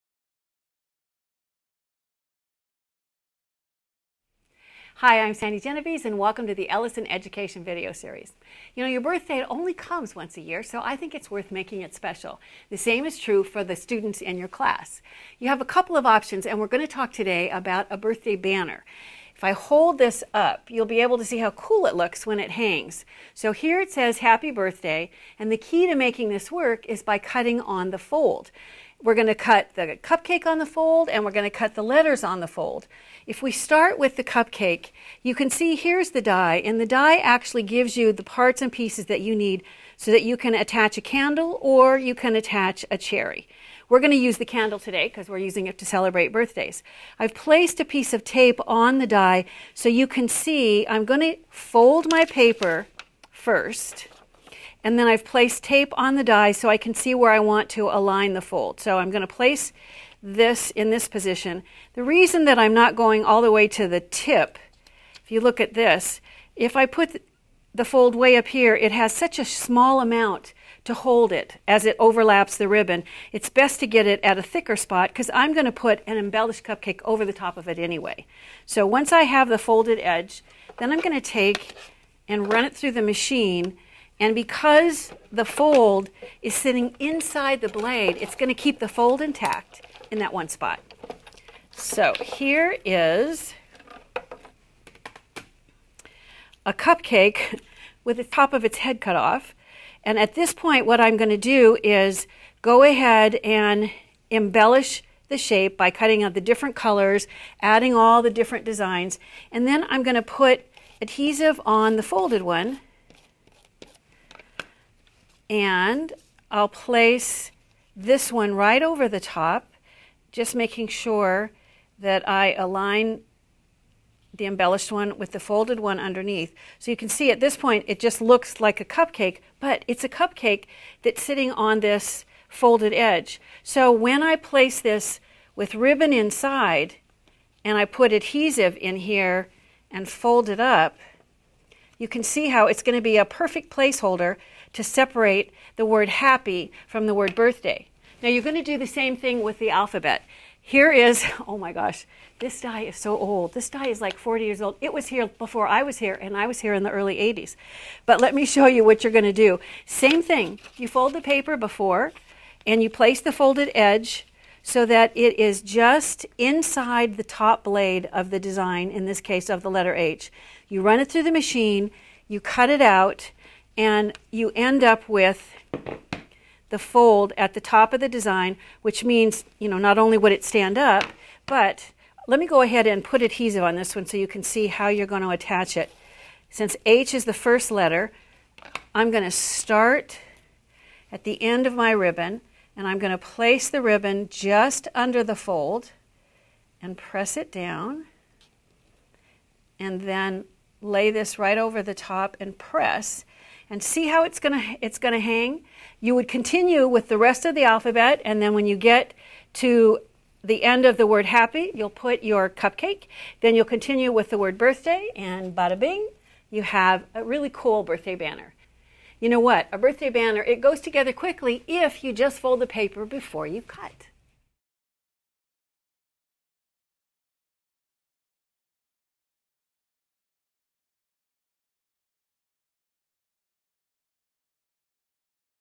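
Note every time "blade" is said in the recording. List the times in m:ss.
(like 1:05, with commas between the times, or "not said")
1:27, 2:47.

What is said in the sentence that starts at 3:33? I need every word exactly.
Then you'll continue with the word birthday and bada bing, you have a really cool birthday banner.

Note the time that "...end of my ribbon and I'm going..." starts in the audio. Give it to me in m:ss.
3:11.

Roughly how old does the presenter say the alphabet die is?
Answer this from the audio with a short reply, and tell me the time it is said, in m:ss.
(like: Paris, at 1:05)
40 years, at 2:34.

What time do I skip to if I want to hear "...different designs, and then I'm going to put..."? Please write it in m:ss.
1:48.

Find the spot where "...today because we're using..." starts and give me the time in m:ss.
0:44.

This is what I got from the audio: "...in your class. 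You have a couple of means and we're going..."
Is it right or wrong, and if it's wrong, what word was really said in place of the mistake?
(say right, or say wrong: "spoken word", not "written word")
wrong: "options", not "means".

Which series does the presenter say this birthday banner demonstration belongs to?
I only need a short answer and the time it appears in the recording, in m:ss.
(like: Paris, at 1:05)
Ellison Education video series, at 0:06.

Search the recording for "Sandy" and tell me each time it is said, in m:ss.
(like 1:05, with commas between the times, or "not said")
0:05.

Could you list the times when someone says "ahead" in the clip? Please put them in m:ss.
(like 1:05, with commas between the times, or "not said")
1:42, 3:02.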